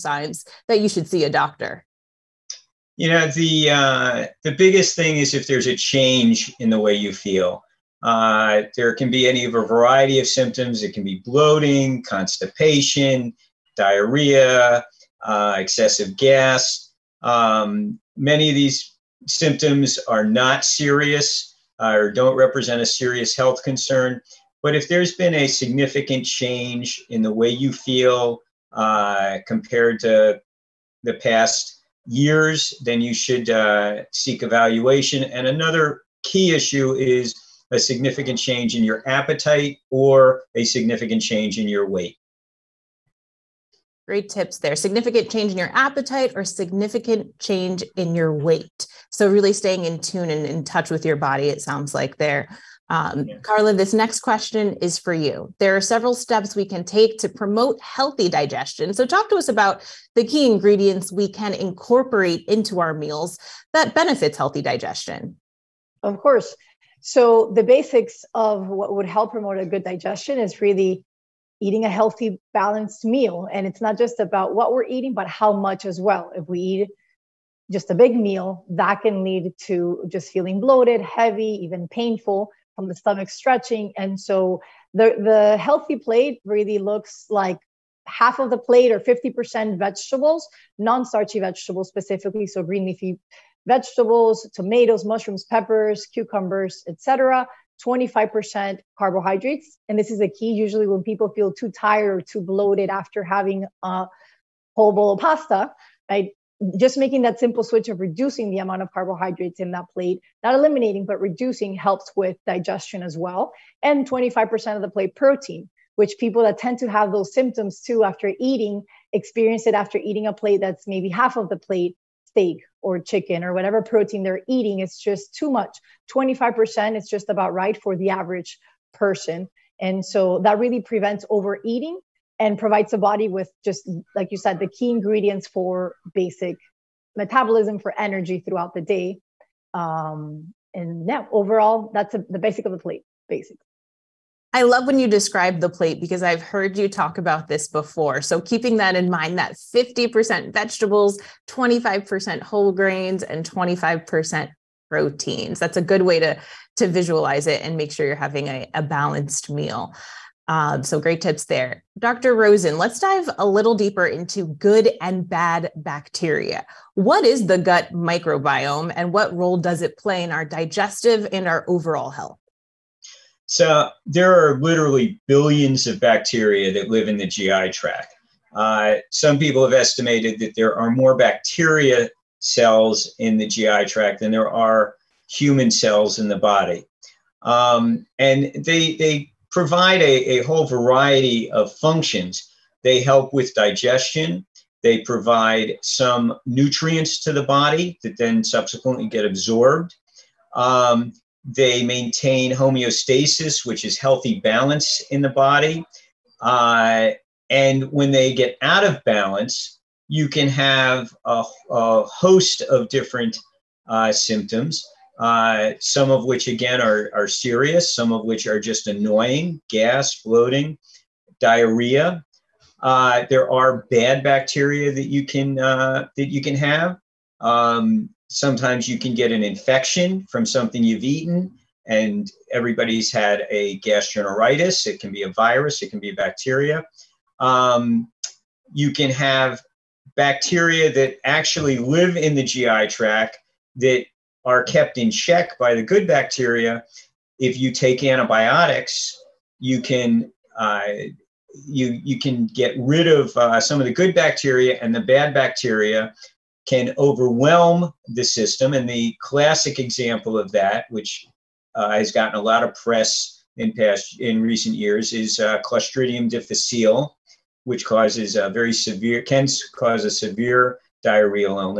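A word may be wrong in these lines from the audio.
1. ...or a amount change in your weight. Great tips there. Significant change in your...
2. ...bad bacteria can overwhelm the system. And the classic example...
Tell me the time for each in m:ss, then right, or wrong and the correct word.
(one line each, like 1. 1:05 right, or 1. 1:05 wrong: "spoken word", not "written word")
1. 0:39 wrong: "significant", not "amount"
2. 4:15 right.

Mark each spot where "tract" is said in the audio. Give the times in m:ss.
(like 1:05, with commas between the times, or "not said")
2:57, 3:03, 4:02.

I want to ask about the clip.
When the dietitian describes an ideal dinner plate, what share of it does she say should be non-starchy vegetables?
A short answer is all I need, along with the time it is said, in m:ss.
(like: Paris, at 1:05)
50%, at 1:28.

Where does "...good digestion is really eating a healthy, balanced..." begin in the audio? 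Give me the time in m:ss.
1:09.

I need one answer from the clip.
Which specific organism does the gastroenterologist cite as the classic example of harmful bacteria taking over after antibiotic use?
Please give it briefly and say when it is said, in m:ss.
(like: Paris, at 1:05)
Clostridium difficile, at 4:25.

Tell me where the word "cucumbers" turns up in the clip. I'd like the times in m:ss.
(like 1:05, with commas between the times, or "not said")
1:36.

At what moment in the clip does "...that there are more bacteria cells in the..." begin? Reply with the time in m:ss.
3:00.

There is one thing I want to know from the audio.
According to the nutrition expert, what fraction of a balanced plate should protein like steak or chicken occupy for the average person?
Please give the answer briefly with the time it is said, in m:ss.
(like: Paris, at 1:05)
25%, at 2:06.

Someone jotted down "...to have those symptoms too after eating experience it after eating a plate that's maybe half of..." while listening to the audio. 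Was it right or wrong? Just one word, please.
right.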